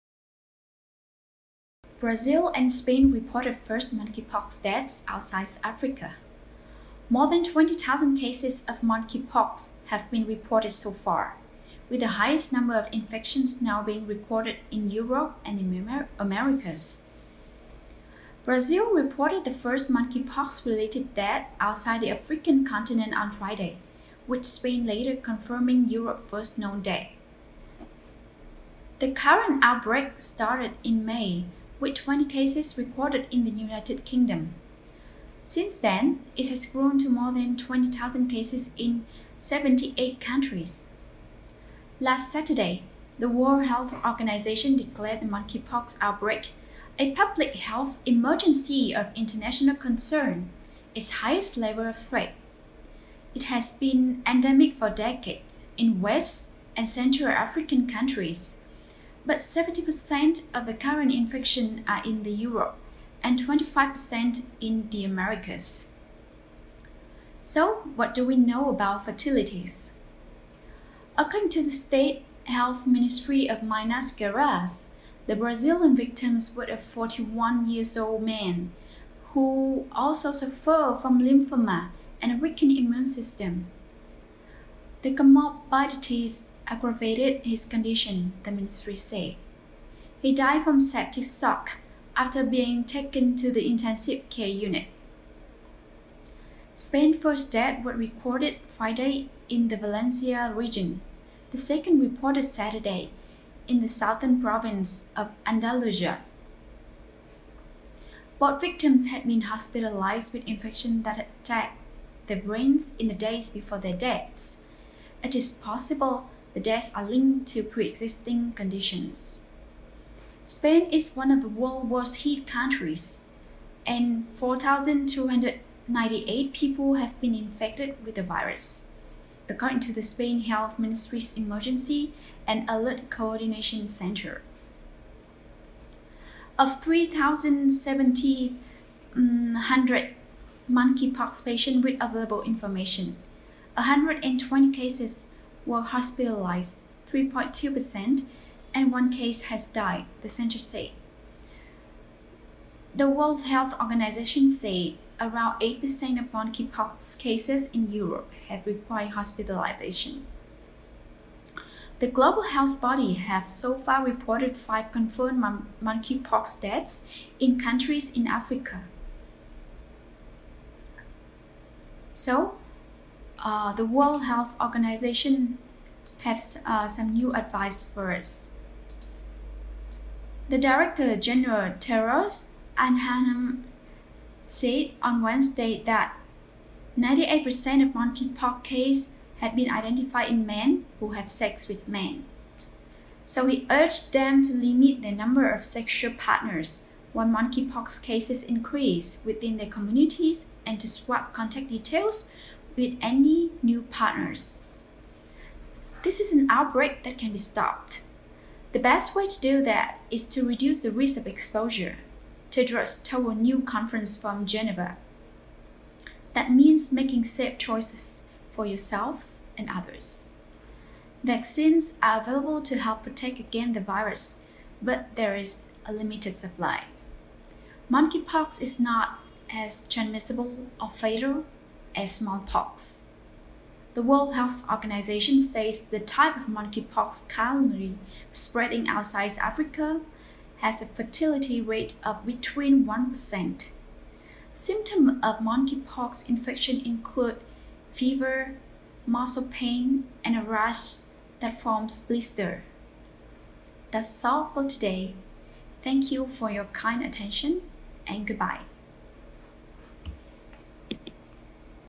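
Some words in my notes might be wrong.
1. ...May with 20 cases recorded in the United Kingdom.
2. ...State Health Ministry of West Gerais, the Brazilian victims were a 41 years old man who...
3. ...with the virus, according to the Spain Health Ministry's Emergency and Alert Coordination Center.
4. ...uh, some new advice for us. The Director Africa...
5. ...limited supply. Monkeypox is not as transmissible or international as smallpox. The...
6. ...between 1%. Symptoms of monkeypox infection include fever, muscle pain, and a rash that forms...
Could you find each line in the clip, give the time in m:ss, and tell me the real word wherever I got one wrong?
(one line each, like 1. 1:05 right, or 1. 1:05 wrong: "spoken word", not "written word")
1. 0:31 right
2. 1:11 wrong: "Minas", not "West"
3. 2:08 right
4. 2:56 wrong: "General", not "Africa"
5. 3:45 wrong: "fatal", not "international"
6. 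4:02 right.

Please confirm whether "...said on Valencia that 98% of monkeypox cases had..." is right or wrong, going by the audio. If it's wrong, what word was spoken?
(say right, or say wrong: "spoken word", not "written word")
wrong: "Wednesday", not "Valencia".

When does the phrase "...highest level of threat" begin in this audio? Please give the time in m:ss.
0:51.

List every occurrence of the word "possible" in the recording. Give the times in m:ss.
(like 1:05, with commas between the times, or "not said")
1:55.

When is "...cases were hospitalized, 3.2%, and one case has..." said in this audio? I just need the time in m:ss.
2:24.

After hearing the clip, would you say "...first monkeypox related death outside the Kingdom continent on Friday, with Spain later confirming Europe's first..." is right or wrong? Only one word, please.
wrong.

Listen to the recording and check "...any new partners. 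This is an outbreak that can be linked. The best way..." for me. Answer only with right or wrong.
wrong.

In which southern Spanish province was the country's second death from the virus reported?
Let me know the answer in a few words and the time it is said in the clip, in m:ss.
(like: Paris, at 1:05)
Andalusia, at 1:45.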